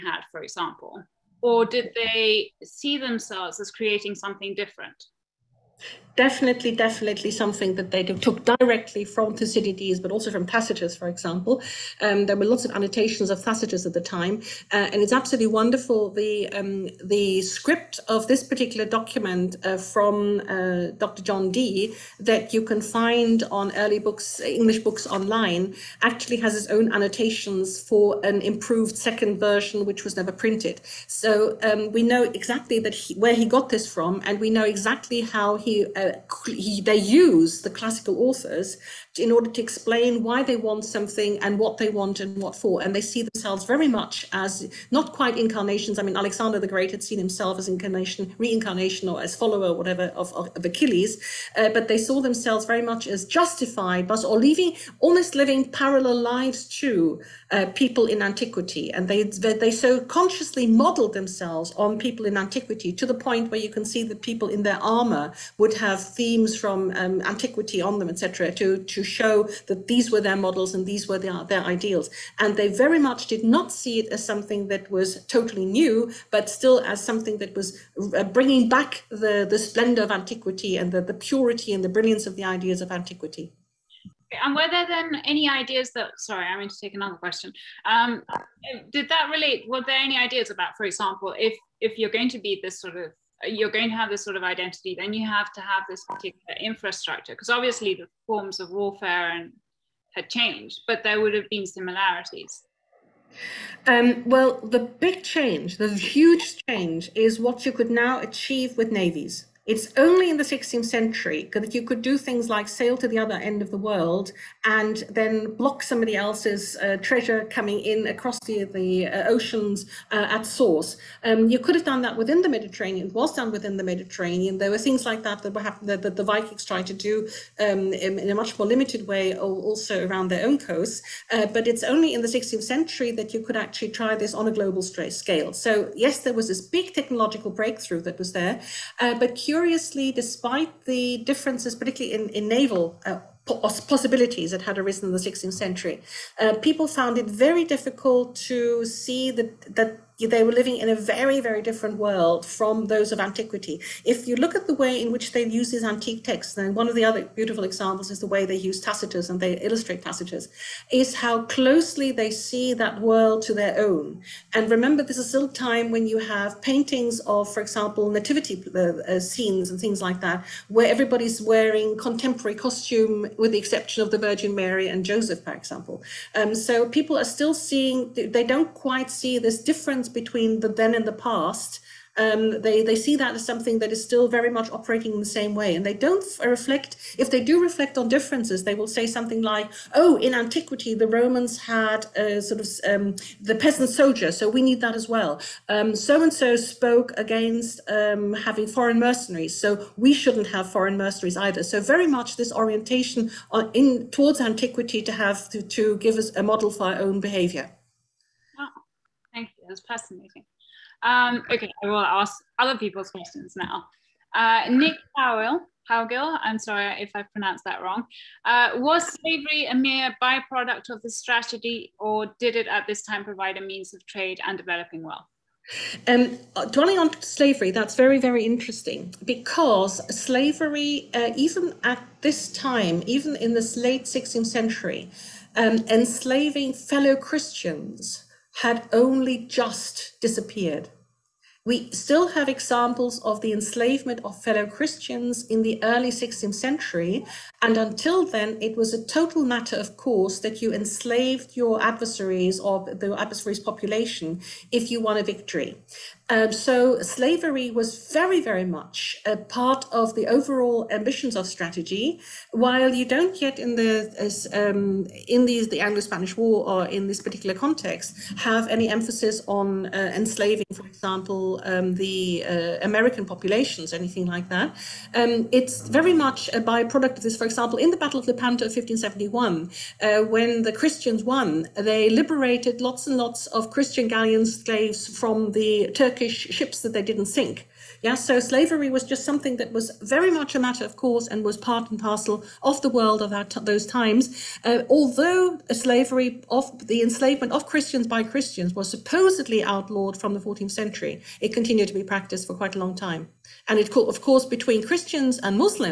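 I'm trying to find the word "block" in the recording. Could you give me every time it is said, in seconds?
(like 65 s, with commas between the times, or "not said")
115 s.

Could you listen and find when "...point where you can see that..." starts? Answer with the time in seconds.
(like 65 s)
63 s.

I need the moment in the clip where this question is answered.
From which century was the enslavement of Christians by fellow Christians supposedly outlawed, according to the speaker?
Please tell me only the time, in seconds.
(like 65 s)
300 s.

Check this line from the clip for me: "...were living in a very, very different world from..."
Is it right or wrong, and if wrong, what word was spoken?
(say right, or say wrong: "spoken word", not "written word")
right.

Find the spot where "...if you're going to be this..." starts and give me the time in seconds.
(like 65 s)
91 s.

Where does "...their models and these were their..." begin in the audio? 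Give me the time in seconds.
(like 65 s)
70 s.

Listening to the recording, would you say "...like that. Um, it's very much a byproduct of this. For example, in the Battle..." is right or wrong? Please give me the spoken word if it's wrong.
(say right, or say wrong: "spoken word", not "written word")
right.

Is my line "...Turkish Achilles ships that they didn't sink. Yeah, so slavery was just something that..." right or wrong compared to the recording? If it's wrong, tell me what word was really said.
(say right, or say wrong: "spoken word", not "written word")
wrong: "Turkish", not "Achilles".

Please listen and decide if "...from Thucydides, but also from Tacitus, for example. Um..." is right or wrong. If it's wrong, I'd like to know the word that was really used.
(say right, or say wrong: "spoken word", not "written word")
right.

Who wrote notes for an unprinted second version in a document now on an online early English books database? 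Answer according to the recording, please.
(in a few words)
Dr. John Dee.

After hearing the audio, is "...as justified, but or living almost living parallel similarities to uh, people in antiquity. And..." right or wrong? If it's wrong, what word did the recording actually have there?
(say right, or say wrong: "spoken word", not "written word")
wrong: "lives", not "similarities".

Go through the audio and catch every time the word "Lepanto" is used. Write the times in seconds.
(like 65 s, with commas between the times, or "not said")
278 s.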